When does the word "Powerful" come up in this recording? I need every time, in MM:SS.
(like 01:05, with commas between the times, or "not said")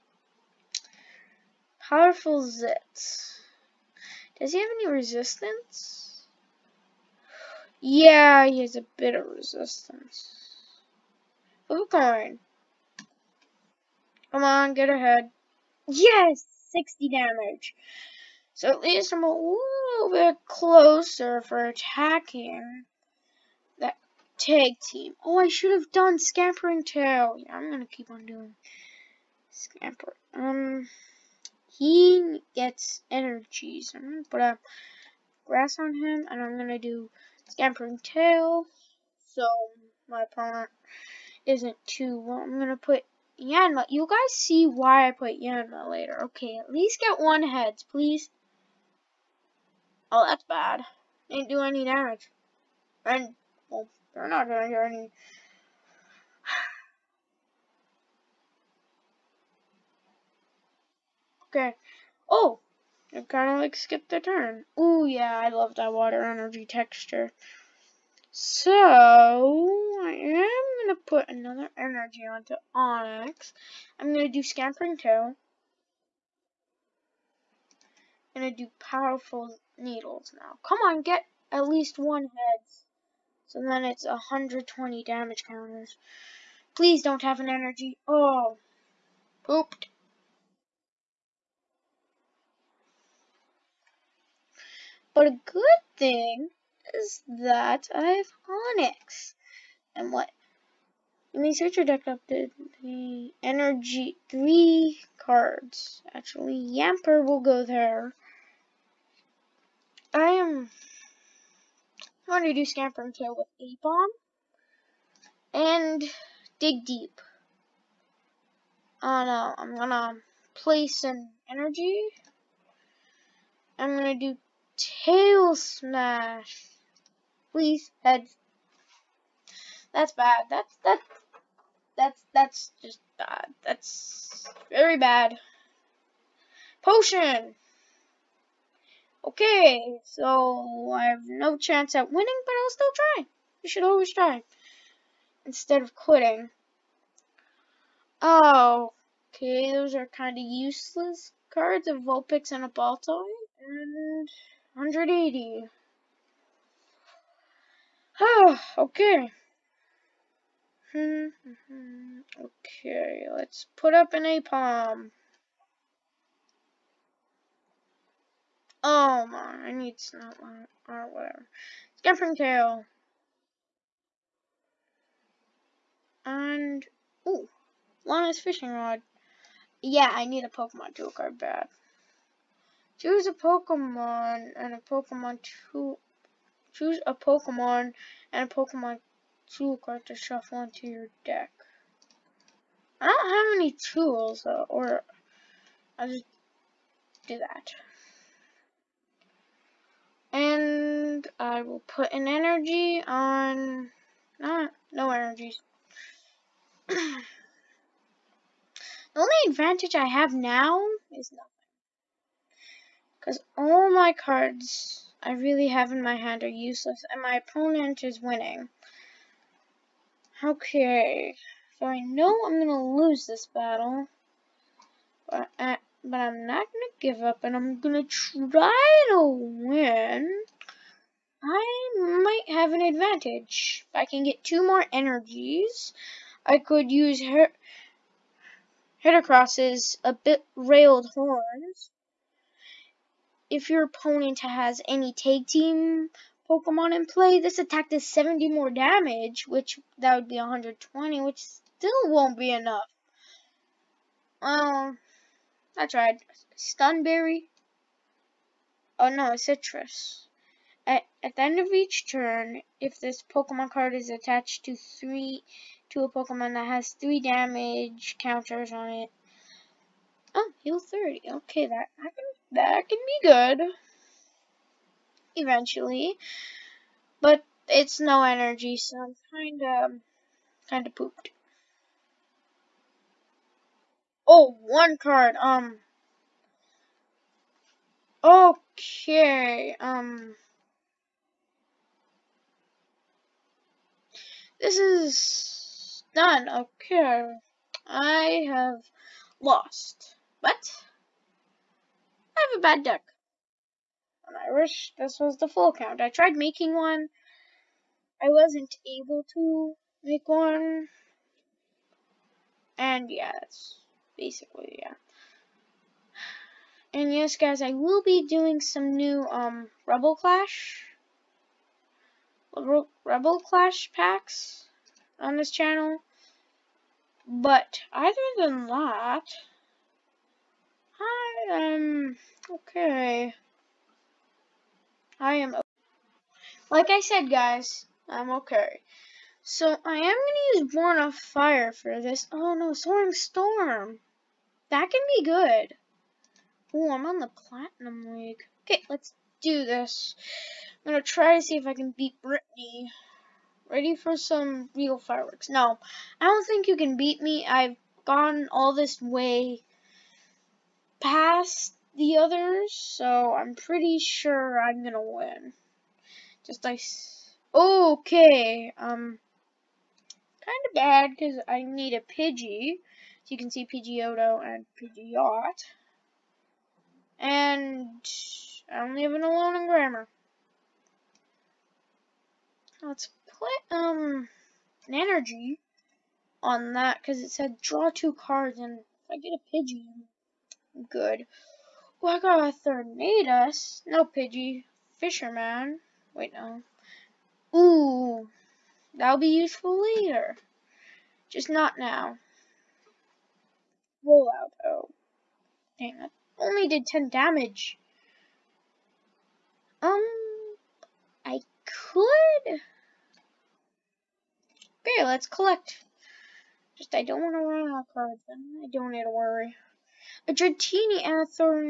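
00:01, 01:18.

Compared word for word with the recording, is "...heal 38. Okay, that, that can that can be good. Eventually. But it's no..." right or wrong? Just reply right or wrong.
wrong.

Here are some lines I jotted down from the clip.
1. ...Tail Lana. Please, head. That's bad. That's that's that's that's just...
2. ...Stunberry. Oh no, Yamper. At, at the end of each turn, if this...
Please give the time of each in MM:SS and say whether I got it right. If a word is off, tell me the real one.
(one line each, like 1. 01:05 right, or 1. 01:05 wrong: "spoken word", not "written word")
1. 02:04 wrong: "Smash", not "Lana"
2. 04:16 wrong: "Sitrus", not "Yamper".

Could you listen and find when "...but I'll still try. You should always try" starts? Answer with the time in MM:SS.
02:22.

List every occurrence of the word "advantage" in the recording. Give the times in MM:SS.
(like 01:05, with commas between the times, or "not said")
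03:29, 03:52.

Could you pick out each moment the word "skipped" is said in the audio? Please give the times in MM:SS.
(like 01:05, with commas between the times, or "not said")
01:03.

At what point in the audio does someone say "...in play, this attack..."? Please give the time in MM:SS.
04:06.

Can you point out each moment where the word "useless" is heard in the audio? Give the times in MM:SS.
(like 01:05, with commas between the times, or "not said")
02:30, 03:36.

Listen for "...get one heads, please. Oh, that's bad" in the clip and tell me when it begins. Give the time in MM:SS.
00:47.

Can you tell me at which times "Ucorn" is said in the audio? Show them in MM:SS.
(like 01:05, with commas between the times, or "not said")
00:11.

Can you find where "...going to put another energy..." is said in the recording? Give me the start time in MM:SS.
01:10.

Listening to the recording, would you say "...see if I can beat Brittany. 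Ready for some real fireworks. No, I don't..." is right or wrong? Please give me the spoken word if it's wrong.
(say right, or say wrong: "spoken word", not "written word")
right.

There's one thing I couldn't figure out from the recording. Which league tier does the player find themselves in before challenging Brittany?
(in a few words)
Platinum.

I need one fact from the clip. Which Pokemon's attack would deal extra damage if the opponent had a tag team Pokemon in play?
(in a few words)
Heracross.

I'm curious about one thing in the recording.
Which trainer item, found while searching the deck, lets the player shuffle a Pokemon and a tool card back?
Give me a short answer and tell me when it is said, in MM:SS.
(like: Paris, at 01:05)
Lana's Fishing Rod, at 02:58.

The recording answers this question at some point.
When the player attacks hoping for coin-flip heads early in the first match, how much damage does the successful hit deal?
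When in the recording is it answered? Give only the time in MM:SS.
00:16.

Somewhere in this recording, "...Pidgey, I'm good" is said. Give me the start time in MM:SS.
06:29.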